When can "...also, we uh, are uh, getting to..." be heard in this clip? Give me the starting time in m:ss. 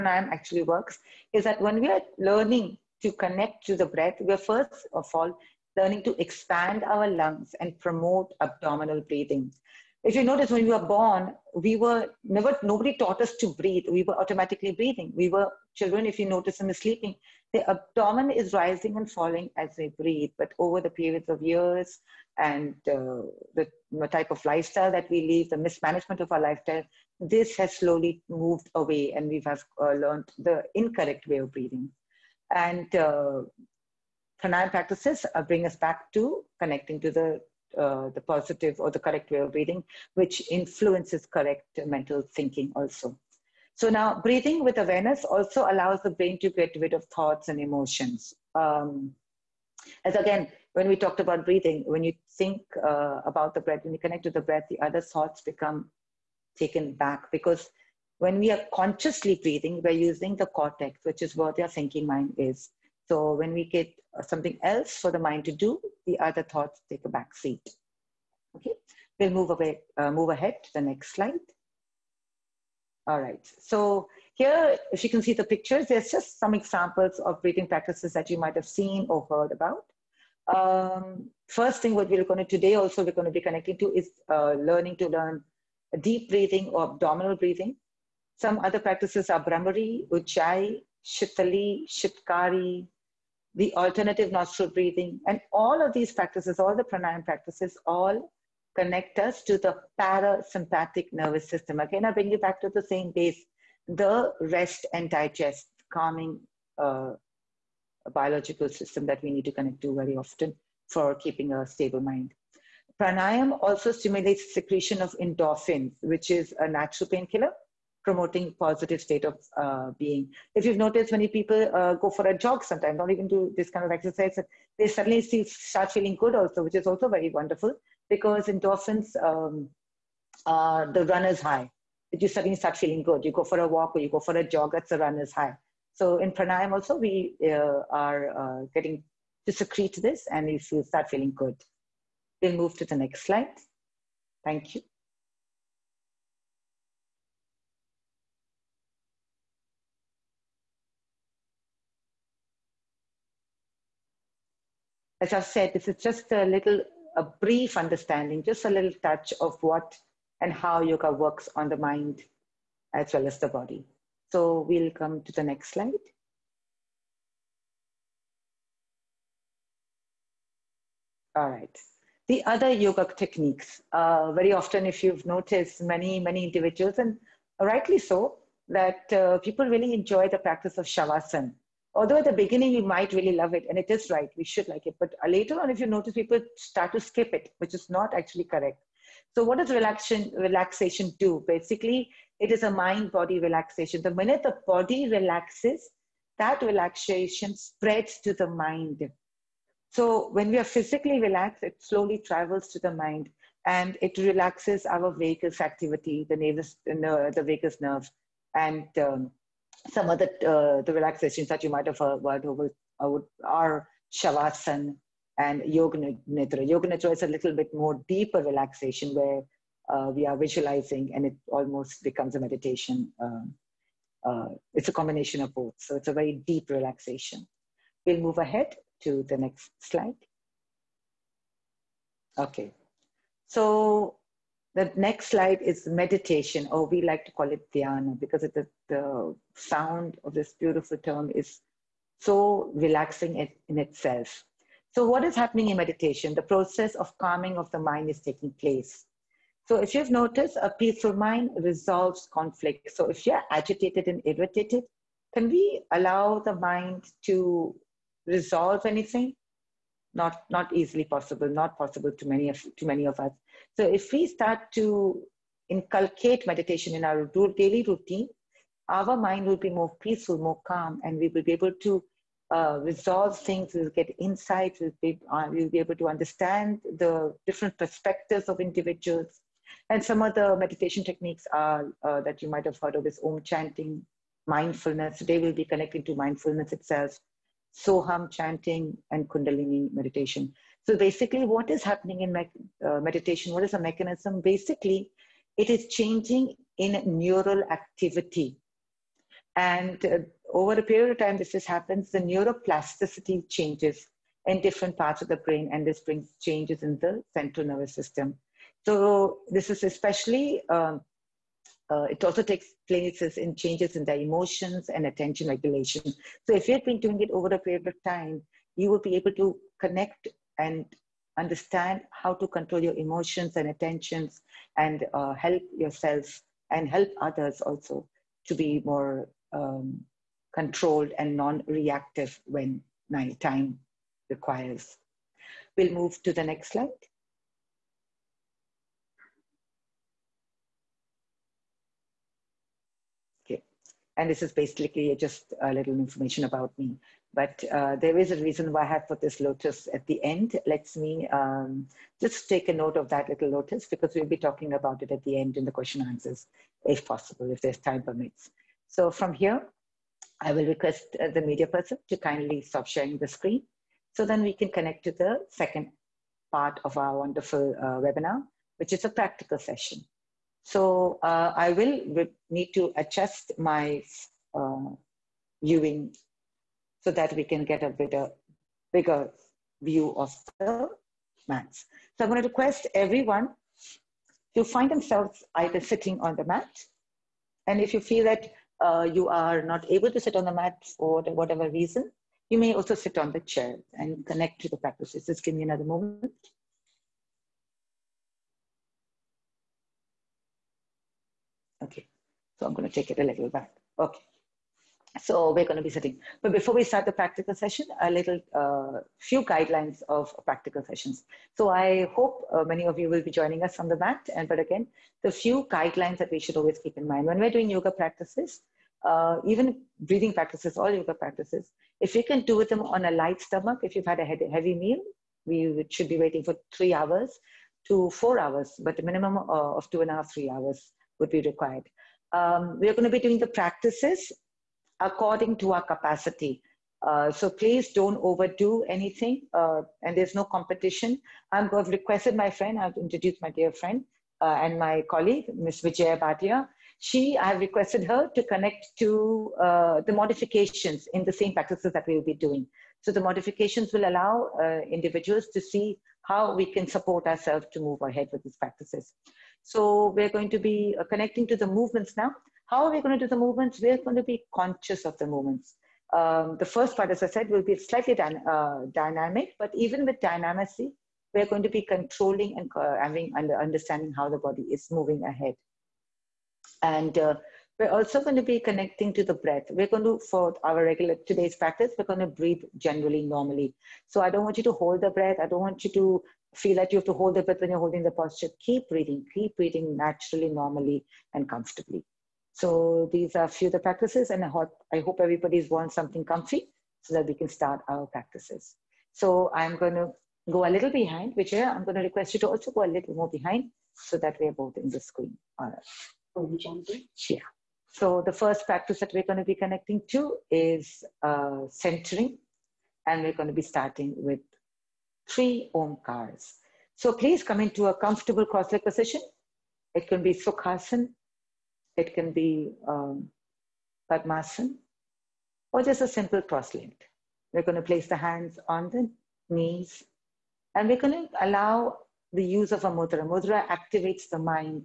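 2:16.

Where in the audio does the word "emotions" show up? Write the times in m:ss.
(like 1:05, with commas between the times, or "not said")
0:47, 5:14, 5:22.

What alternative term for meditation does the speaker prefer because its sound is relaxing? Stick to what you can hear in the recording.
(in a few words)
dhyana.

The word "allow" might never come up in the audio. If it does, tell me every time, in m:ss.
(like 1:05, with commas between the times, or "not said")
0:45, 4:15, 7:34, 8:51.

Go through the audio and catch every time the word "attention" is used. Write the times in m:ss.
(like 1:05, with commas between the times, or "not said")
5:15, 5:23.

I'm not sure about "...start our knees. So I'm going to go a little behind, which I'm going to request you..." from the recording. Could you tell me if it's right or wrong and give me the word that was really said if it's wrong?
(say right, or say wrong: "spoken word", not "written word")
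wrong: "practices", not "knees".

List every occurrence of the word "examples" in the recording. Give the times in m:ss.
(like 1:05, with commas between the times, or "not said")
1:16.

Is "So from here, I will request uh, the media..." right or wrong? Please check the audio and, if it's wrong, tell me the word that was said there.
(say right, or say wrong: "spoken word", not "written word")
right.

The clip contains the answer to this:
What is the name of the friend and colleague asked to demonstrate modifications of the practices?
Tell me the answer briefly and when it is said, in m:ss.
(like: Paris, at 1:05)
Vijaya Bhatia, at 7:25.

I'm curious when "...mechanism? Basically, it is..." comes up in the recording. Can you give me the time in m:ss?
4:53.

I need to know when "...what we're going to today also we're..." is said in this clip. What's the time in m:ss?
1:21.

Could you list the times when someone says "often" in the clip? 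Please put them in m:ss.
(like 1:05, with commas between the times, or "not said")
1:50, 2:54.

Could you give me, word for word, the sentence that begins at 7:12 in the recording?
Um, we are going to be doing the practices according to our capacity.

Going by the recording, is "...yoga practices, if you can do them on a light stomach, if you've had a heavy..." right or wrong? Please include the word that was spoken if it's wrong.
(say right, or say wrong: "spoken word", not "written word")
right.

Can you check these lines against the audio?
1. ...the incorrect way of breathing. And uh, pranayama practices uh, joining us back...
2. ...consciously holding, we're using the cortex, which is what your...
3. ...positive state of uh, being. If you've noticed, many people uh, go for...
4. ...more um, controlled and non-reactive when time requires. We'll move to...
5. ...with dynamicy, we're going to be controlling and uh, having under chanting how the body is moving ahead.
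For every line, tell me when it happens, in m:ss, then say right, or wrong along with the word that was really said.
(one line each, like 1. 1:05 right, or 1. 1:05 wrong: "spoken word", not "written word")
1. 0:30 wrong: "bring", not "joining"
2. 0:58 wrong: "breathing", not "holding"
3. 1:58 right
4. 5:28 right
5. 7:50 wrong: "understanding", not "chanting".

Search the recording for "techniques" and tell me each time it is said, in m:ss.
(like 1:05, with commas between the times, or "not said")
2:53, 4:41.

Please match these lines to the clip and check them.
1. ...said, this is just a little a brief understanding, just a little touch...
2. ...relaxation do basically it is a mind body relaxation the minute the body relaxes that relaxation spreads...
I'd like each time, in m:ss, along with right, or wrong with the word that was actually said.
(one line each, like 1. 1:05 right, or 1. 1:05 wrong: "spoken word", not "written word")
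1. 2:35 right
2. 3:10 right.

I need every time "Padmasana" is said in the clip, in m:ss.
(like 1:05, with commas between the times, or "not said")
8:44.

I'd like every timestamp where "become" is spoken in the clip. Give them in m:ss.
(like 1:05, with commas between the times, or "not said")
0:55, 3:42.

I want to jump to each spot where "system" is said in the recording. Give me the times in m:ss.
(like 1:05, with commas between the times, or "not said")
1:41, 1:48, 5:07.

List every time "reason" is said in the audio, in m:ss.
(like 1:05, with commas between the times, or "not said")
5:48, 6:31.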